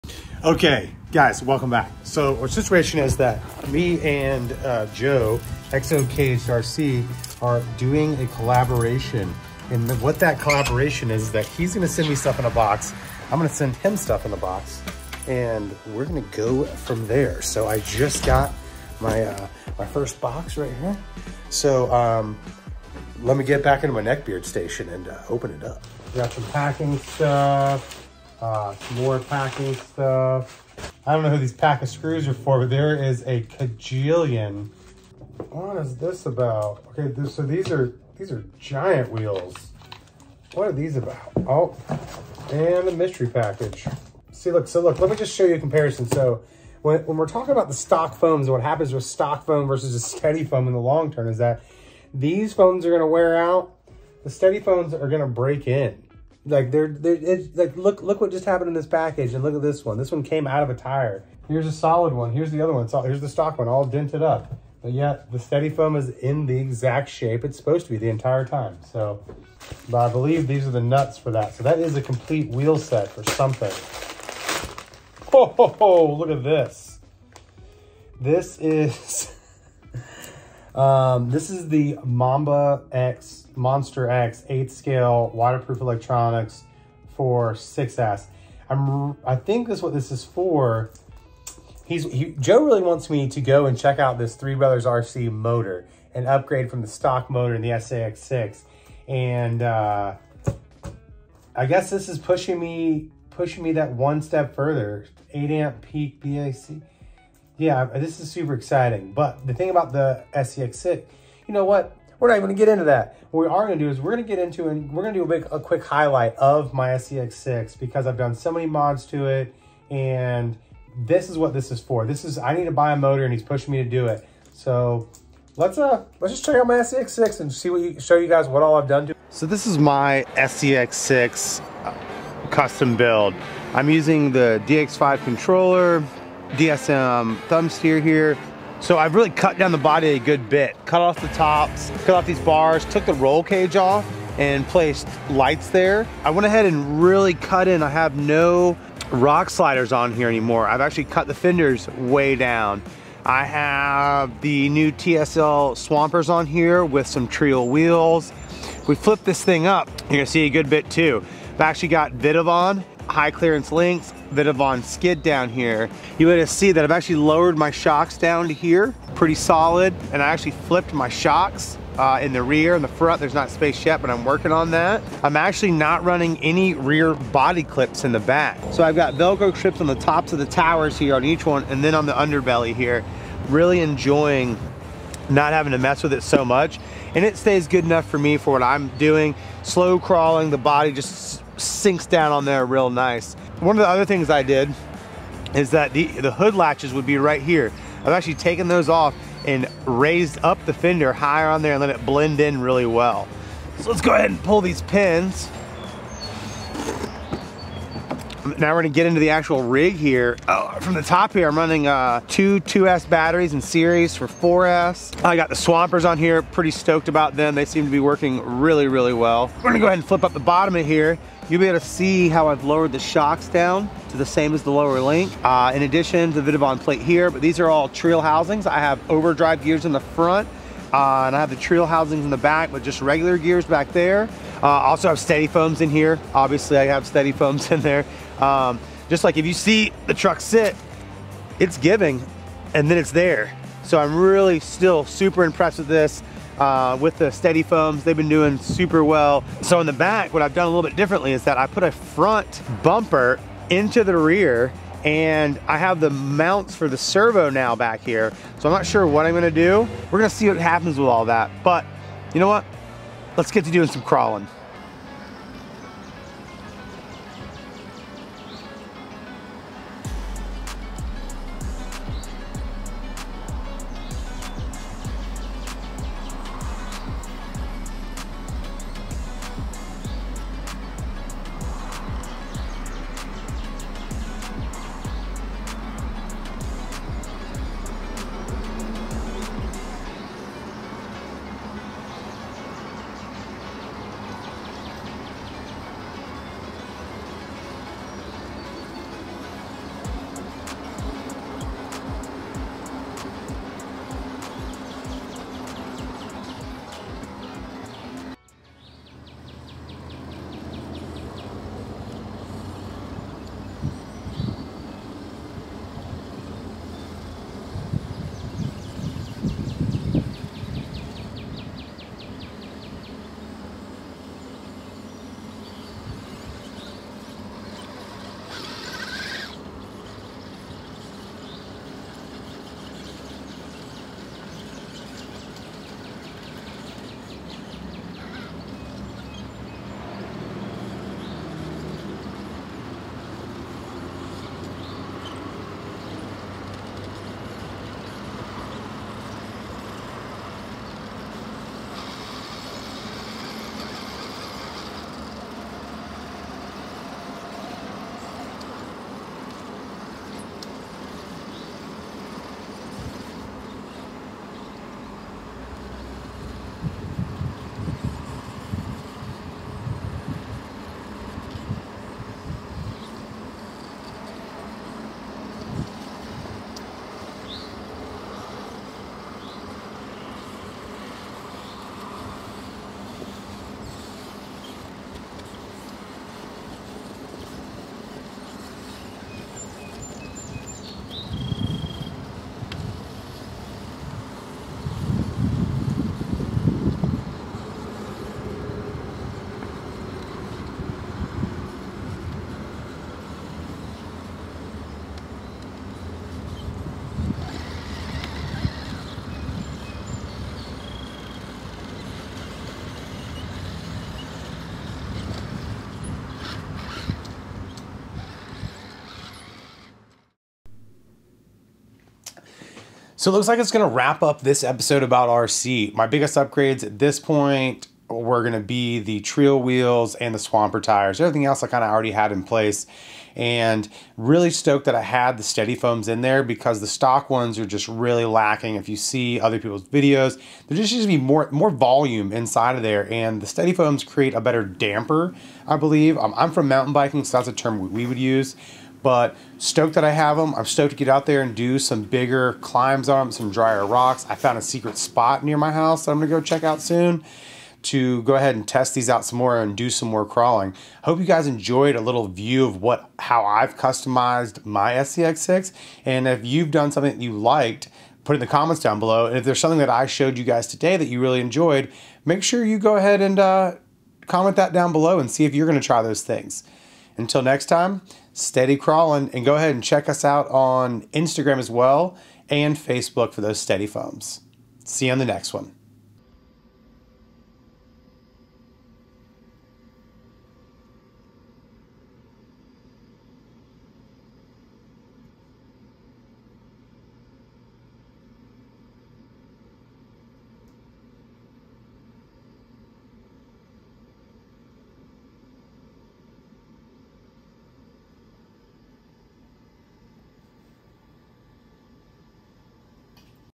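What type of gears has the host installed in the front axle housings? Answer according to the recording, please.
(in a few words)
Overdrive gears.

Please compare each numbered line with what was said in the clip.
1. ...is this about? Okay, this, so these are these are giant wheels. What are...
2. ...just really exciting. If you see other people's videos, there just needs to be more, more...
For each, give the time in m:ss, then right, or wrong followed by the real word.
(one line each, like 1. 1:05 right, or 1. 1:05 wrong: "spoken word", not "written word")
1. 0:35 right
2. 7:17 wrong: "lacking", not "exciting".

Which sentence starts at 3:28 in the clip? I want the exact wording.
Now we're gonna get into the actual rig here.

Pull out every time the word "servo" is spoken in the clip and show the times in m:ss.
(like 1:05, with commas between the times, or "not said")
4:16.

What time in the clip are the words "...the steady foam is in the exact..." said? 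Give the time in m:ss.
1:05.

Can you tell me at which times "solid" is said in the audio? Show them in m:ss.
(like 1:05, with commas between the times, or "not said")
1:01, 2:49.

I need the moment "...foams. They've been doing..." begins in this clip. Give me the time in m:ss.
4:07.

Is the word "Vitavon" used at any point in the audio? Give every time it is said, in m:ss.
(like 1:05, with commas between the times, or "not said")
2:42, 3:46.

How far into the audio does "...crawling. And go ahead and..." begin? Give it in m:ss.
7:58.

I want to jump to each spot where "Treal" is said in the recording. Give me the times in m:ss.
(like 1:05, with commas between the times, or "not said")
2:37, 7:09.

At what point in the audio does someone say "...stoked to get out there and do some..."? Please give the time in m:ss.
7:30.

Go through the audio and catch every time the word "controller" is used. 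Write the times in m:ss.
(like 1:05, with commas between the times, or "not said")
2:15.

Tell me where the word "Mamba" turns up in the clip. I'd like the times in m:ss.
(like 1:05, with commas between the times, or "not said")
1:22.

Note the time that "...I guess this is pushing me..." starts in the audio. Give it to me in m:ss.
1:41.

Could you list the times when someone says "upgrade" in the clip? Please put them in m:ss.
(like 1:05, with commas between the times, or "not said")
1:36, 7:06.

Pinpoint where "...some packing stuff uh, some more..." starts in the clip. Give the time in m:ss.
0:26.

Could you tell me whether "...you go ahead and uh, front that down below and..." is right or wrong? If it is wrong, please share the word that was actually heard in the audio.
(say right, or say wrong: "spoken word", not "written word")
wrong: "comment", not "front".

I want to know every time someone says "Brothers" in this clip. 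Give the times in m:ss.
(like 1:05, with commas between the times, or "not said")
1:34.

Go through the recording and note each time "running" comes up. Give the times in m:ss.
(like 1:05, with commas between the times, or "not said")
2:56, 3:31.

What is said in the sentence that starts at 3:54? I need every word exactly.
Uh, also have steady foams in here.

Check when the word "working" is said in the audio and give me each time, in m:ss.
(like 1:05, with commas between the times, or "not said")
2:54, 3:37.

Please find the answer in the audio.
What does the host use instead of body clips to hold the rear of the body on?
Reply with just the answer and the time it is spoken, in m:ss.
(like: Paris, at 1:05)
Velcro, at 2:59.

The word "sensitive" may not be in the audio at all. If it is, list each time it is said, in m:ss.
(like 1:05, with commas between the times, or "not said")
not said.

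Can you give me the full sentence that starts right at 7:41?
Hope you guys enjoyed a little view of what how I've customized my SCX6.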